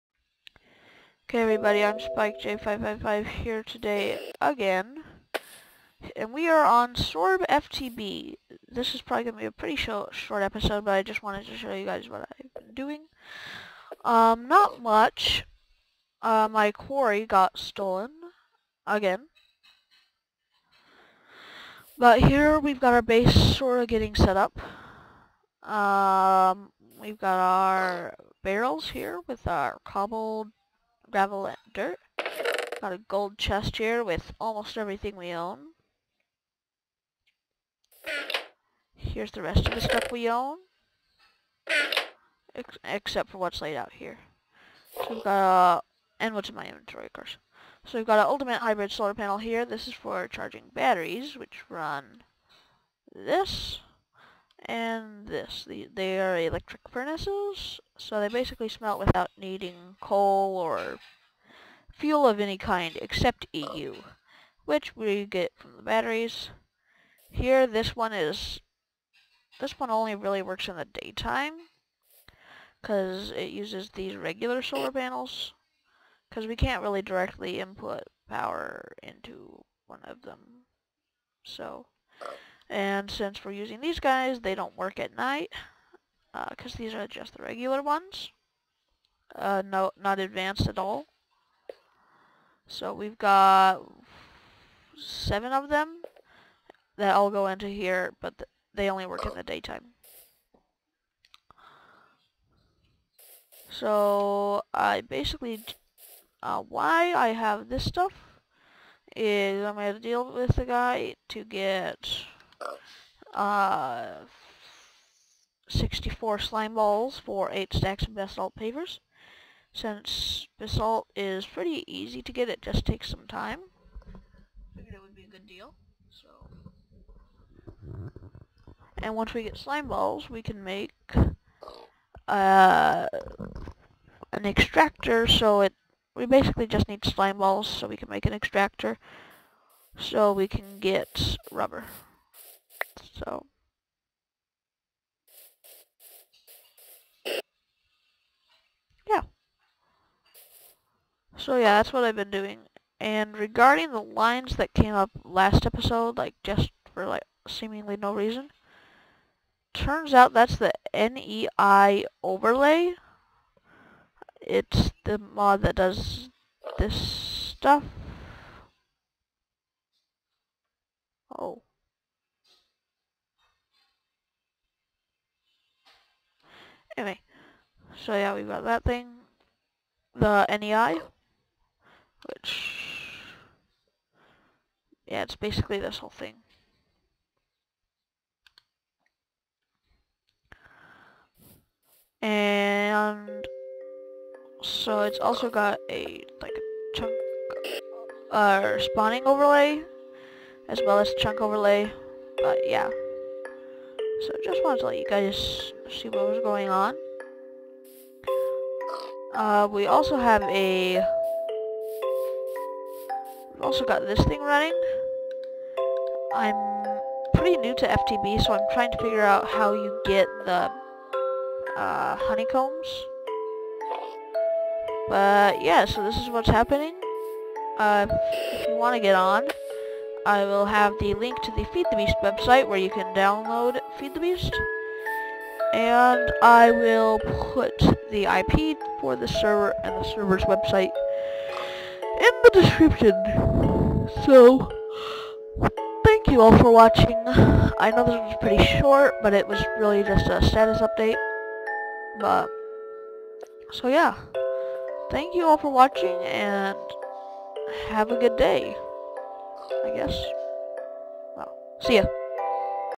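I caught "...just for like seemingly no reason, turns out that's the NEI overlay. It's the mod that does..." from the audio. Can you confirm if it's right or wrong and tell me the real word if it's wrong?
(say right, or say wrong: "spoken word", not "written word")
right.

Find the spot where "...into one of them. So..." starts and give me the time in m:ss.
1:19.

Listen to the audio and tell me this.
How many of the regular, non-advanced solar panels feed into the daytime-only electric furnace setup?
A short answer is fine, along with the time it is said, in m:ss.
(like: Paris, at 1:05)
7, at 1:34.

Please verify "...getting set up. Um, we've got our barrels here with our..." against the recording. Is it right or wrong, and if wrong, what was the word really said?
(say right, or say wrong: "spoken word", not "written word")
right.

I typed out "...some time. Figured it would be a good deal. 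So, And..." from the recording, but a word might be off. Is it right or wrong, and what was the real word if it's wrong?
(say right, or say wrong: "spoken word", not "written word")
right.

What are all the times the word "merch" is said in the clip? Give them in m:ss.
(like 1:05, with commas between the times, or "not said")
not said.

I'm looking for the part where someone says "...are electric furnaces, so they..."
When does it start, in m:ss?
0:56.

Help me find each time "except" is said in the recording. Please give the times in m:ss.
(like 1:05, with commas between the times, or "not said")
0:42, 1:03.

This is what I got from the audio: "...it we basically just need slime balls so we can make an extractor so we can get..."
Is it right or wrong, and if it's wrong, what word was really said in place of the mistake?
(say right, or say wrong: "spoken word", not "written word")
right.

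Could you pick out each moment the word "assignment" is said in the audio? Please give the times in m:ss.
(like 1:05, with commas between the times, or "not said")
not said.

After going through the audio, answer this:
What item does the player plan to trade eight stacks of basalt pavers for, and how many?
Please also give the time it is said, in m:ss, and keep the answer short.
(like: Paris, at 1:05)
64 slime balls, at 1:55.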